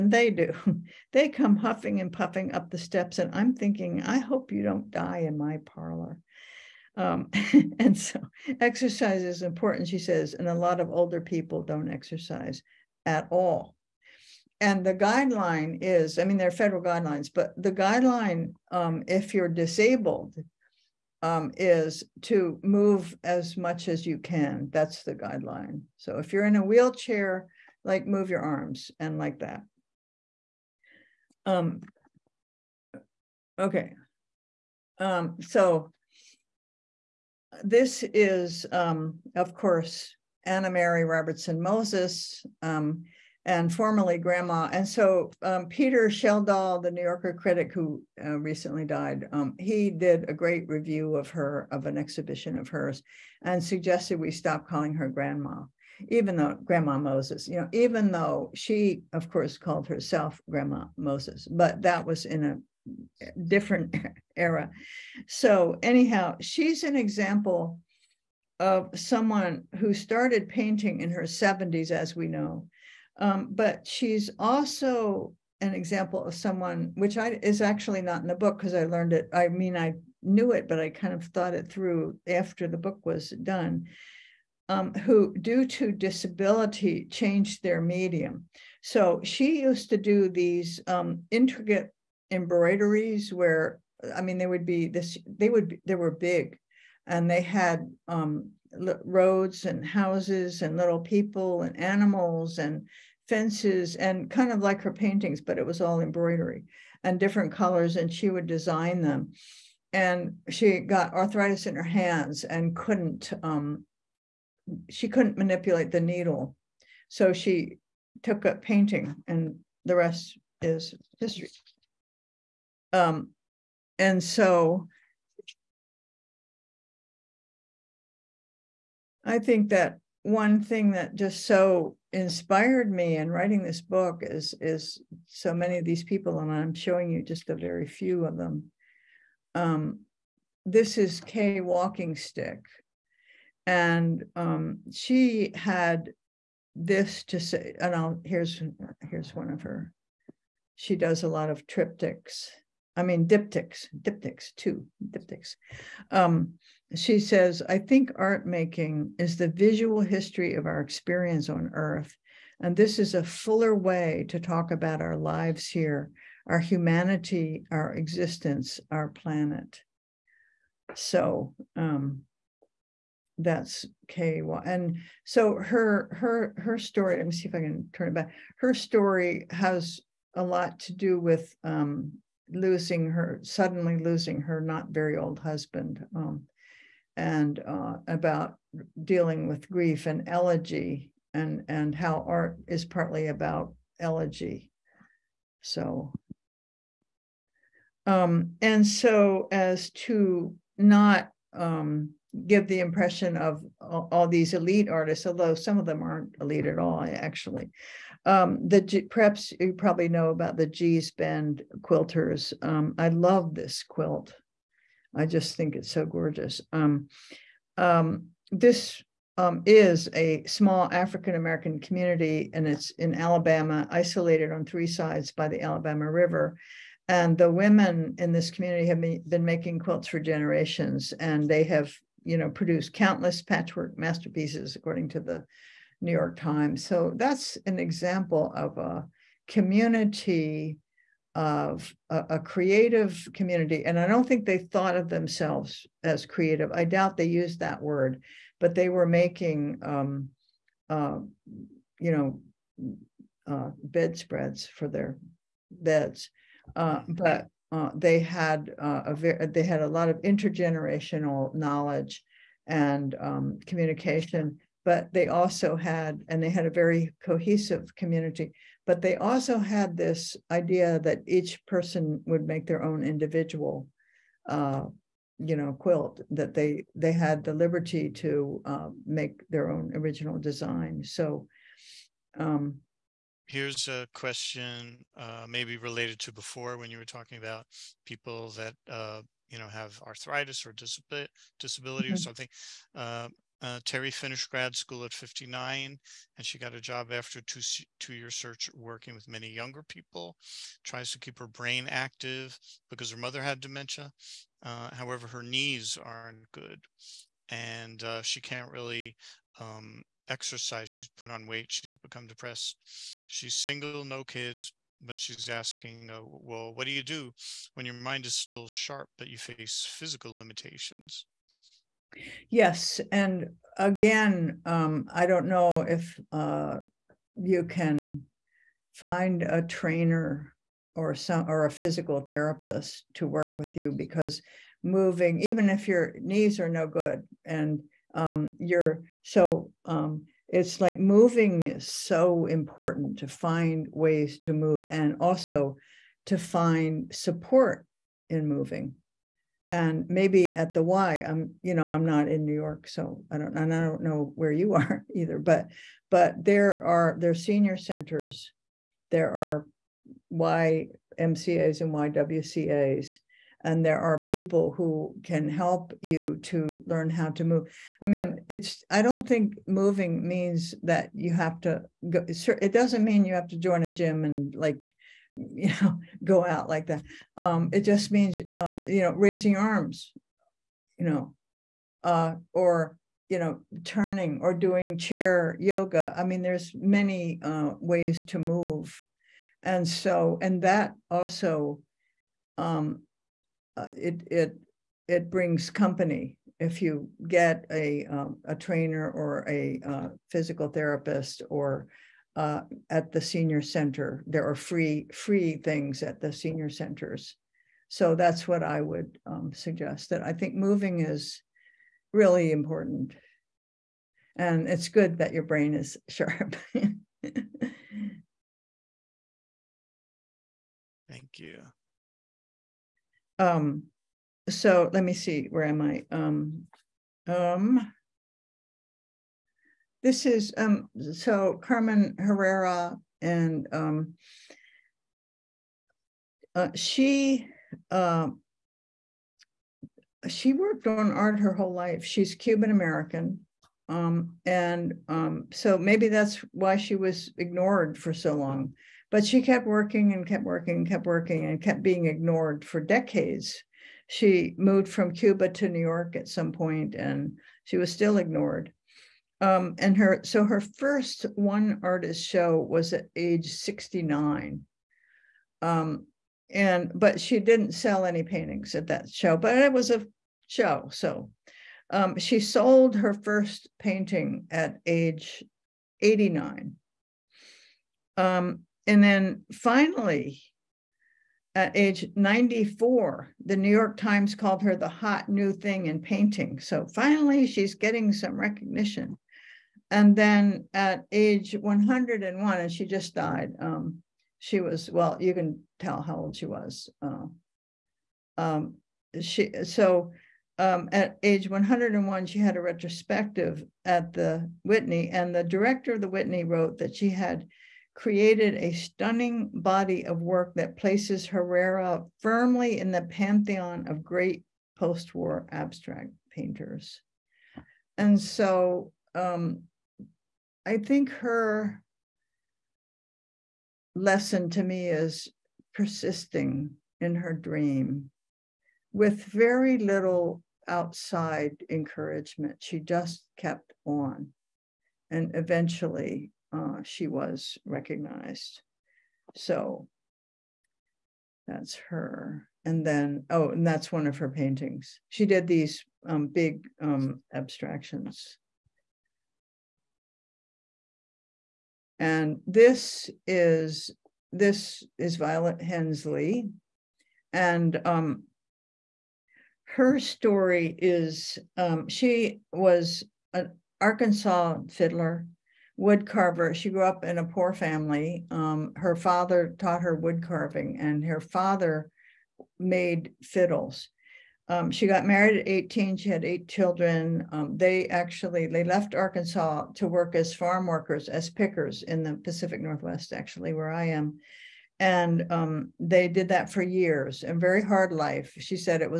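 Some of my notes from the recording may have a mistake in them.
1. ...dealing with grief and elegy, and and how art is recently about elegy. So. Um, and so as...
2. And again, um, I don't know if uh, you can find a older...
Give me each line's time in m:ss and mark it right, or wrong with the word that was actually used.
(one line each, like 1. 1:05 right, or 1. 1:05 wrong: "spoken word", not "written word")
1. 3:09 wrong: "partly", not "recently"
2. 5:23 wrong: "trainer", not "older".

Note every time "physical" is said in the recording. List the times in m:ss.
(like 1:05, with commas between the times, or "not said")
5:19, 5:31, 6:40.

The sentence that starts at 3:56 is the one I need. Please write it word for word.
So that's an example of a community of a, a, creative community.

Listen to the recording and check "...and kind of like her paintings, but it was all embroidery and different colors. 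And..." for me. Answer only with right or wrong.
right.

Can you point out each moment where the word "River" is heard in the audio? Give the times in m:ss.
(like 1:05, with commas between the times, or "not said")
3:46.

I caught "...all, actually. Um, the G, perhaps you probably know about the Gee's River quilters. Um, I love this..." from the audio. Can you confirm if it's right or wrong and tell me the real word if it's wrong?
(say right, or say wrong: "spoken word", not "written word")
wrong: "Bend", not "River".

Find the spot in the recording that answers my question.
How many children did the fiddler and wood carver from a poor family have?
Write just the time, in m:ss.
9:36.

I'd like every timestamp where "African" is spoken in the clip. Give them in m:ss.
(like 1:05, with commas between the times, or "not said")
3:40.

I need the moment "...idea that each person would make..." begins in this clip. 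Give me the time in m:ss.
4:30.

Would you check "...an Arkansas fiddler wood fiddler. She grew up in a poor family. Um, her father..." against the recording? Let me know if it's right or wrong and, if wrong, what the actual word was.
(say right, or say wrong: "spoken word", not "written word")
wrong: "carver", not "fiddler".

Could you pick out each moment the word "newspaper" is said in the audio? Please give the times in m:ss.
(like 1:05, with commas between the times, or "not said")
not said.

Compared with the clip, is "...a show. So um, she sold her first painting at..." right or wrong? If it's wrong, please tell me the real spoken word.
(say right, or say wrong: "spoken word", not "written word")
right.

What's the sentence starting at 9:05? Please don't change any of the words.
She did these um, big um, abstractions.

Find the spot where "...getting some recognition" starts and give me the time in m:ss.
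8:07.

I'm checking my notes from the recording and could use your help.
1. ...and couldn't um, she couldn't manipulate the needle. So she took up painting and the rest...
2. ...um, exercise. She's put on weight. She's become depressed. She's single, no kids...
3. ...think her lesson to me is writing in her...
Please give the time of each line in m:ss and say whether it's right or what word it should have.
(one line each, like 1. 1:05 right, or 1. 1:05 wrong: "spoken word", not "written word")
1. 1:52 right
2. 5:09 right
3. 8:40 wrong: "persisting", not "writing".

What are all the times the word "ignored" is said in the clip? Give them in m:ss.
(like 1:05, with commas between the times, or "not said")
7:27, 7:32, 7:38.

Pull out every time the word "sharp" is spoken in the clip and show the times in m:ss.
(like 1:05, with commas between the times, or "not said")
5:18, 6:56.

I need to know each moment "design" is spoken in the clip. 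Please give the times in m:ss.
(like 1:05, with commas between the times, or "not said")
1:48, 4:40.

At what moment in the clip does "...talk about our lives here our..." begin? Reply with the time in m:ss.
2:44.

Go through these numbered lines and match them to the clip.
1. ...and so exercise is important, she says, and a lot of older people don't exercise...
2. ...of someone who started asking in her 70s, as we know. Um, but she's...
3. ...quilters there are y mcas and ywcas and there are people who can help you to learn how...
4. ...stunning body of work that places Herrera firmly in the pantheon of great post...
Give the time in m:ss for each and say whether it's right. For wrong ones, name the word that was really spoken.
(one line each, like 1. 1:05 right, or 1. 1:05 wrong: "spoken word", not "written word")
1. 0:07 right
2. 1:08 wrong: "painting", not "asking"
3. 5:57 wrong: "centers", not "quilters"
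4. 8:28 right.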